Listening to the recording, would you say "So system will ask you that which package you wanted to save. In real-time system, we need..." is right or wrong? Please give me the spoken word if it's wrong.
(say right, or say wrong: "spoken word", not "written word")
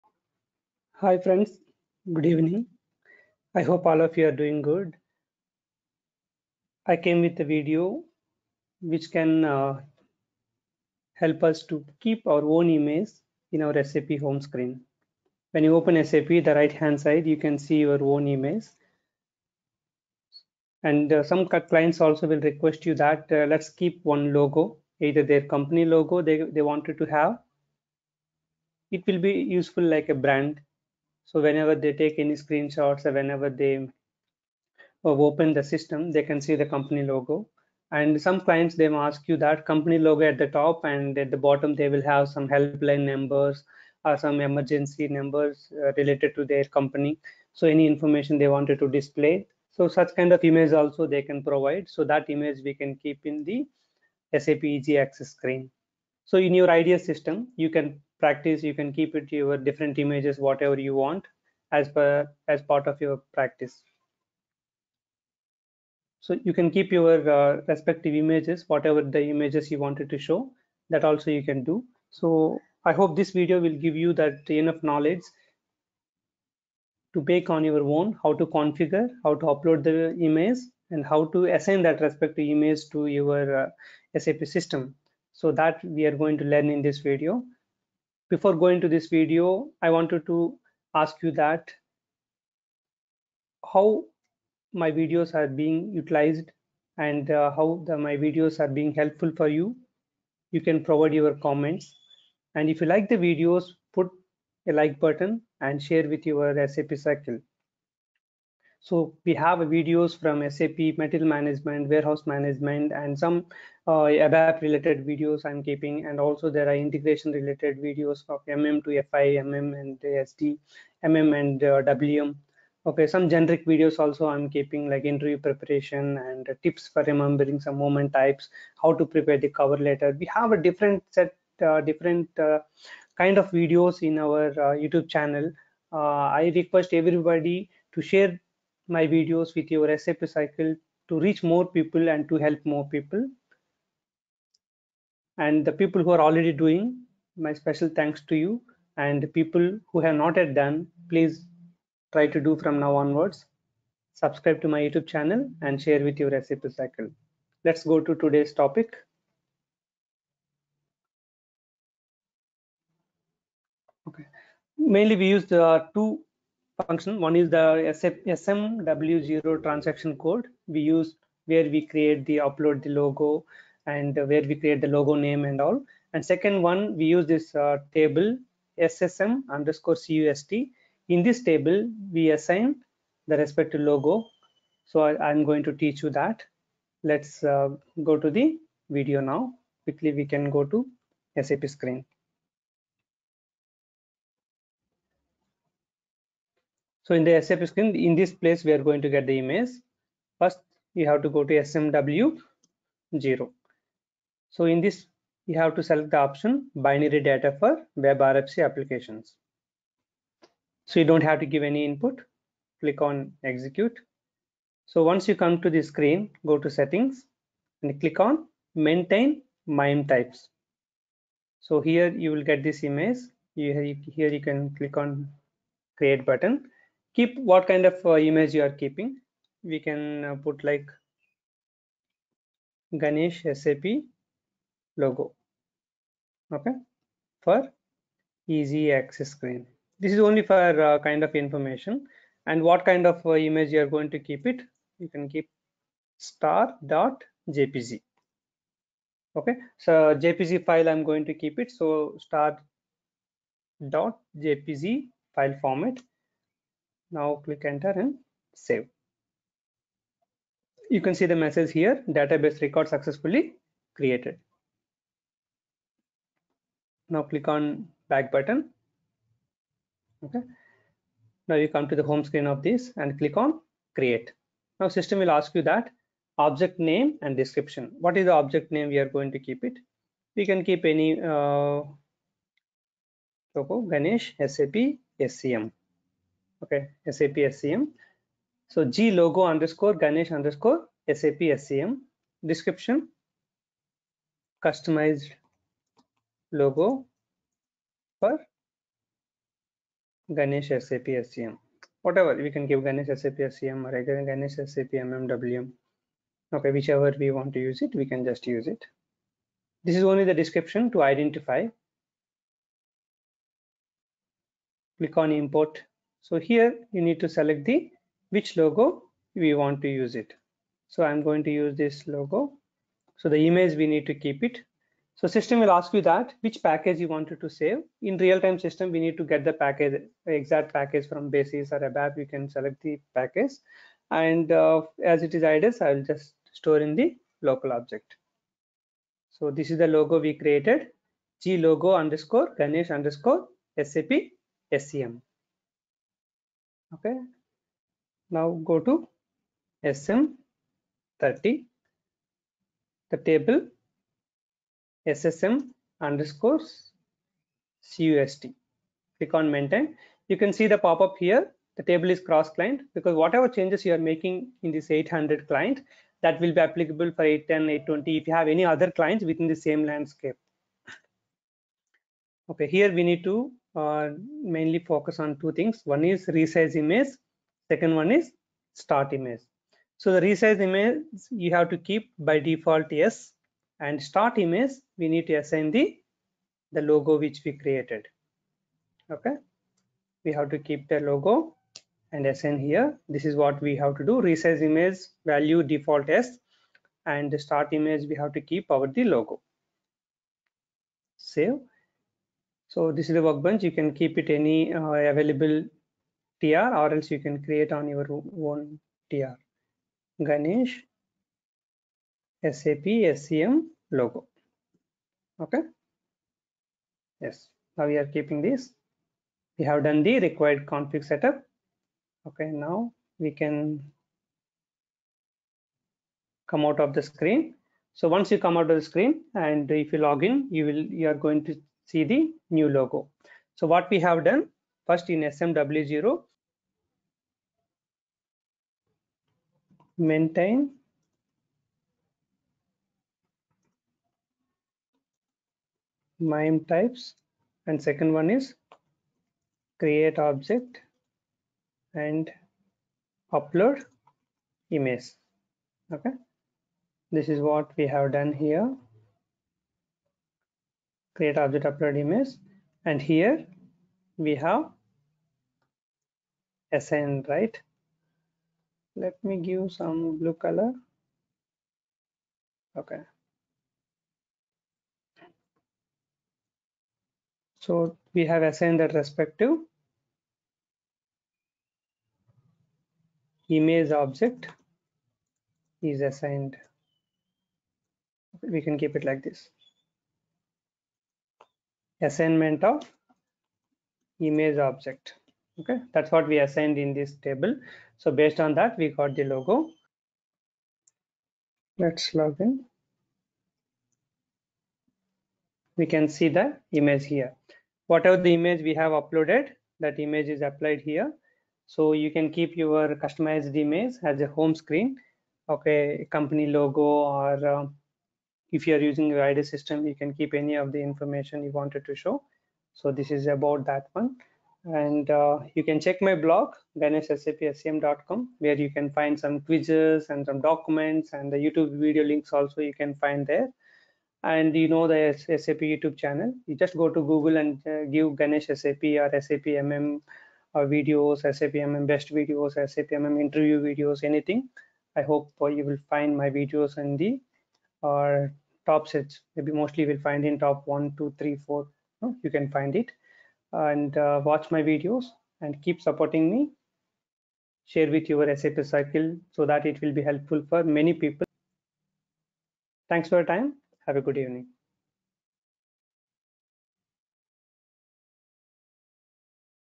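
right.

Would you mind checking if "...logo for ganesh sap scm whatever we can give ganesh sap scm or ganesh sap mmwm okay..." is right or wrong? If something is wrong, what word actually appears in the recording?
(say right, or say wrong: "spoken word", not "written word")
right.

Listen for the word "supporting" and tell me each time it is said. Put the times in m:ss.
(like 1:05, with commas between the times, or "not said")
9:15.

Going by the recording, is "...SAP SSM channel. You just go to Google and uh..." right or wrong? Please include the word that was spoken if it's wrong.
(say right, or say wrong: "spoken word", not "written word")
wrong: "YouTube", not "SSM".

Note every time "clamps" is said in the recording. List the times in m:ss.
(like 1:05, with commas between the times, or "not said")
not said.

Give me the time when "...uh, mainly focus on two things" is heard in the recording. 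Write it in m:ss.
6:13.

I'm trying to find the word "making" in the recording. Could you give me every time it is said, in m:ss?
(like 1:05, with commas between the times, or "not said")
6:04.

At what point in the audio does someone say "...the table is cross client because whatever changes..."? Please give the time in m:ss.
6:01.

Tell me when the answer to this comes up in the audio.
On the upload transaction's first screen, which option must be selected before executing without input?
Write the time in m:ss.
3:26.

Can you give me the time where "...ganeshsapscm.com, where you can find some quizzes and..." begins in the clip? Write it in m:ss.
8:46.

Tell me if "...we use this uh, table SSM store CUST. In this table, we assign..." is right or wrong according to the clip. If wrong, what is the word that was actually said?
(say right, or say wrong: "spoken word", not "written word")
wrong: "underscore", not "store".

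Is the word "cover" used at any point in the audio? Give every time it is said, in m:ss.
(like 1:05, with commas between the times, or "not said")
2:09.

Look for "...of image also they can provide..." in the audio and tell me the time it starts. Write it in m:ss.
0:50.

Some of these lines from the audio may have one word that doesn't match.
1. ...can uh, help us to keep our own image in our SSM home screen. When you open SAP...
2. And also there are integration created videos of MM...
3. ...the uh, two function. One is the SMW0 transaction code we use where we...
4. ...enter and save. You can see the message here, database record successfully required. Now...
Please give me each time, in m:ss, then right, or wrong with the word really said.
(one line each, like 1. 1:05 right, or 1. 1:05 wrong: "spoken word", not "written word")
1. 0:09 wrong: "SAP", not "SSM"
2. 1:56 wrong: "related", not "created"
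3. 2:45 right
4. 4:17 wrong: "created", not "required".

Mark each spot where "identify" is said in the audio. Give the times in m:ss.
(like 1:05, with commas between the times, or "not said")
5:11.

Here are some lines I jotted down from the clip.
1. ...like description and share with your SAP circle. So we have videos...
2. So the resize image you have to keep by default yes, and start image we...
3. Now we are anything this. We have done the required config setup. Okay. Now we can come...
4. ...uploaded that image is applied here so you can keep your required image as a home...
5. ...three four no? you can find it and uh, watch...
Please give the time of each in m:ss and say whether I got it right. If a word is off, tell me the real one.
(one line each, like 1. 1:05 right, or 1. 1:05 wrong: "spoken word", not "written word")
1. 1:44 wrong: "button", not "description"
2. 6:19 right
3. 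6:57 wrong: "keeping", not "anything"
4. 8:28 wrong: "customized", not "required"
5. 9:11 right.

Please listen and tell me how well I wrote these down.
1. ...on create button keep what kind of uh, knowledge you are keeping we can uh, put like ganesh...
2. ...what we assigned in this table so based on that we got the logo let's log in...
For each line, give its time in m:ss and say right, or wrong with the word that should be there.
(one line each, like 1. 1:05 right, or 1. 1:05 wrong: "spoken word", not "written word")
1. 3:44 wrong: "image", not "knowledge"
2. 8:16 right.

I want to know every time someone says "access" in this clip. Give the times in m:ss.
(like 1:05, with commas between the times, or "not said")
0:55, 3:58.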